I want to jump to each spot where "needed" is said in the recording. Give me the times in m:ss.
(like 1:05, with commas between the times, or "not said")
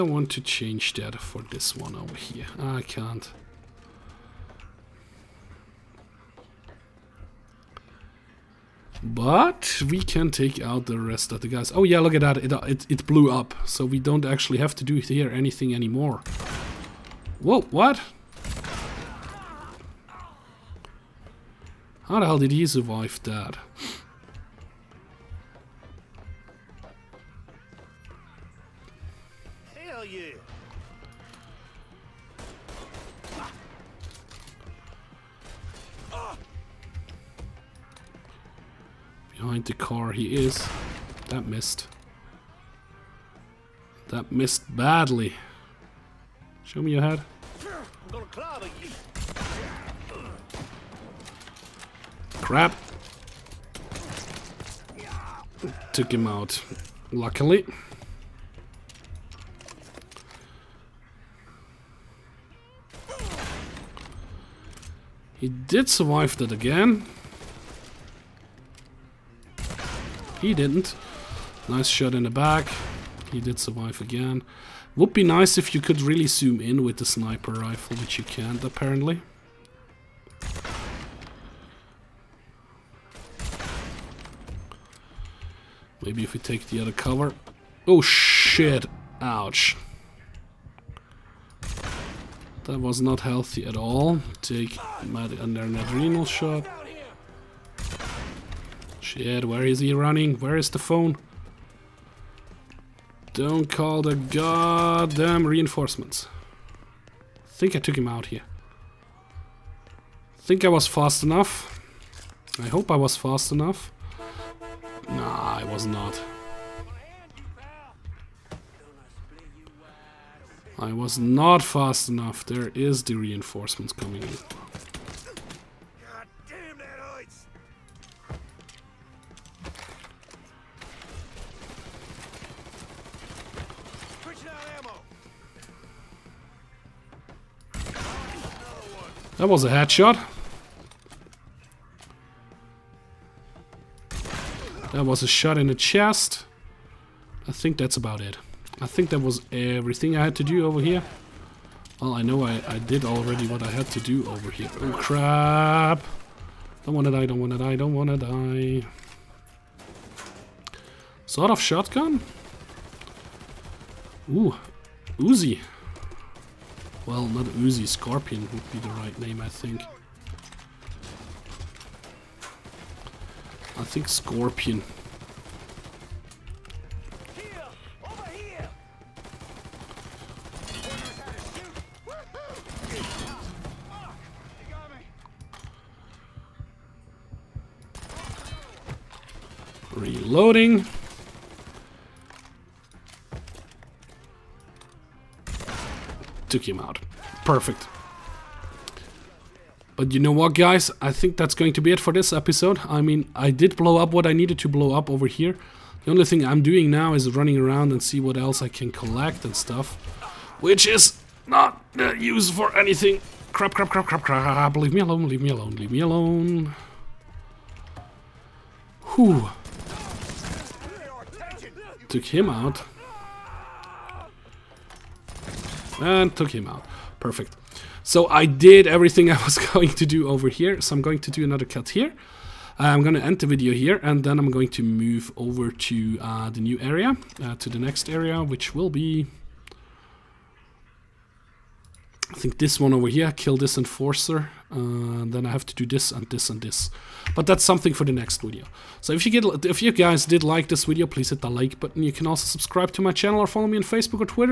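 3:24.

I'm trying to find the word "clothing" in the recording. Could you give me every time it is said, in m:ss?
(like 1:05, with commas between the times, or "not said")
not said.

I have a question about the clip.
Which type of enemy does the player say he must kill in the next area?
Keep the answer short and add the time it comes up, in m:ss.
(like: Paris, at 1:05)
Enforcer, at 4:03.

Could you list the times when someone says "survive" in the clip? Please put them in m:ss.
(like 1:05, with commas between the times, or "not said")
0:22, 1:05, 1:13.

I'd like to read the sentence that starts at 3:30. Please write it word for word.
Which is not uh, used for anything.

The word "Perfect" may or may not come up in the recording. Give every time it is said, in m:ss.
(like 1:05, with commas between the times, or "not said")
3:17, 3:47.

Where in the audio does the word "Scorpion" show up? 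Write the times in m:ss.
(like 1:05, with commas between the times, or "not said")
2:47, 2:54.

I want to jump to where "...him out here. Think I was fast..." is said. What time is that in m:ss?
1:47.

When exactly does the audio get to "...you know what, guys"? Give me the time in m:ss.
3:20.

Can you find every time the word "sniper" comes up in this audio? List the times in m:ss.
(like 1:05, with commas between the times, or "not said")
1:17.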